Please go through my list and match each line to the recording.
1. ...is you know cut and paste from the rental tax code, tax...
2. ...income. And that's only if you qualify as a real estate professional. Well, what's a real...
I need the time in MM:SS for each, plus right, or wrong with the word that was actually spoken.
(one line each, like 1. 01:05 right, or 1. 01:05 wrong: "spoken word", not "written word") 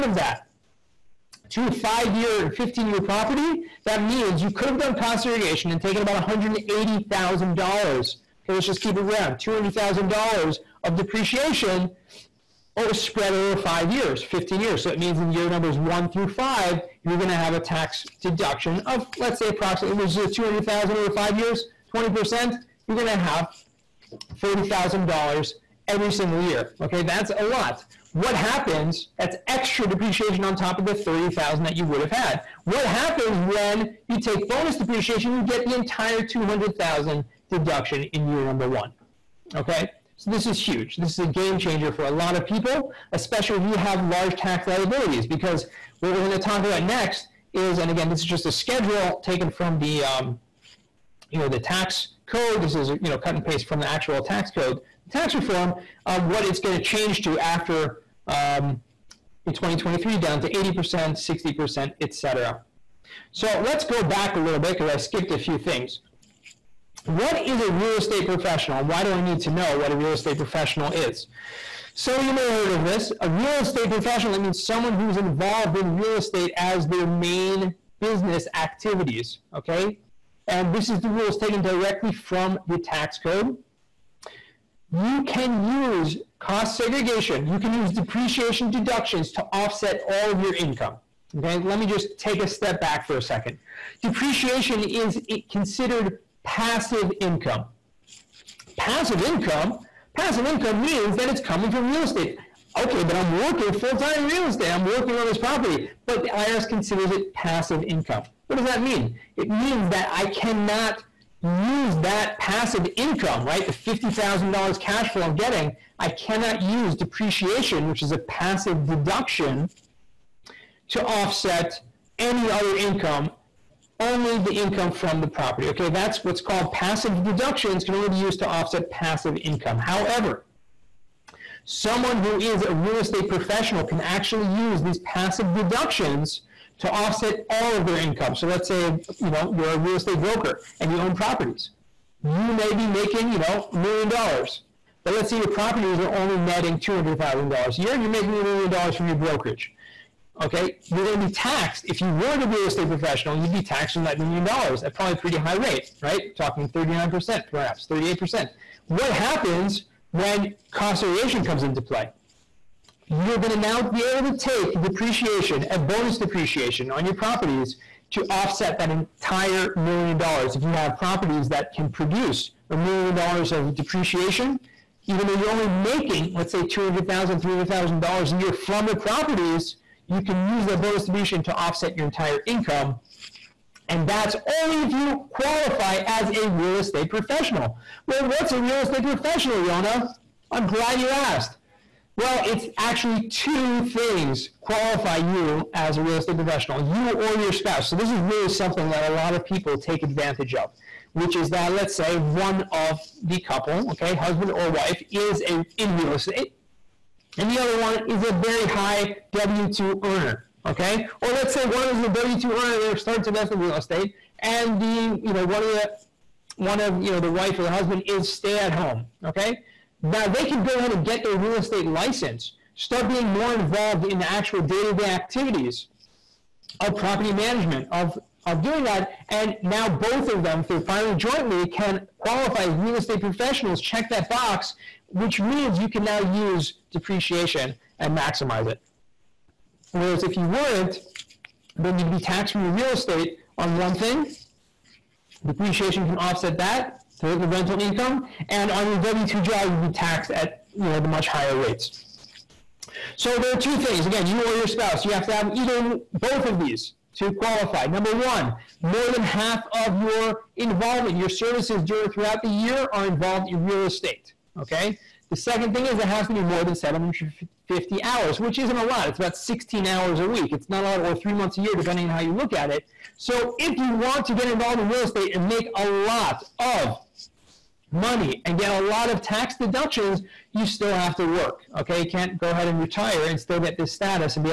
1. 00:52 wrong: "actual", not "rental"
2. 03:02 right.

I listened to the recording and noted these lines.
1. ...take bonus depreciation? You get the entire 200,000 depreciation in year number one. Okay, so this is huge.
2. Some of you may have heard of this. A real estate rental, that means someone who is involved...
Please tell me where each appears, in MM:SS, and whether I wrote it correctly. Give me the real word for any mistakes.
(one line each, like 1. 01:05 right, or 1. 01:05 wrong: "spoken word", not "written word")
1. 00:34 wrong: "deduction", not "depreciation"
2. 01:11 wrong: "professional", not "rental".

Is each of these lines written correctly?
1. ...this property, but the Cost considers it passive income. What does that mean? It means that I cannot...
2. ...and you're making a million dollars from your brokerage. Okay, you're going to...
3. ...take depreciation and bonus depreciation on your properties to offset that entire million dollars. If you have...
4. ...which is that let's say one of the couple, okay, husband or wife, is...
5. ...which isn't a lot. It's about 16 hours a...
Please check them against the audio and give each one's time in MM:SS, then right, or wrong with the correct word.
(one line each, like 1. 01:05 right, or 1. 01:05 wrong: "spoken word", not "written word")
1. 01:45 wrong: "IRS", not "Cost"
2. 02:27 right
3. 02:44 right
4. 03:21 right
5. 04:28 right.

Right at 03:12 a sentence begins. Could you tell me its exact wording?
Well, it's actually two things qualify you as a real estate professional, you or your spouse.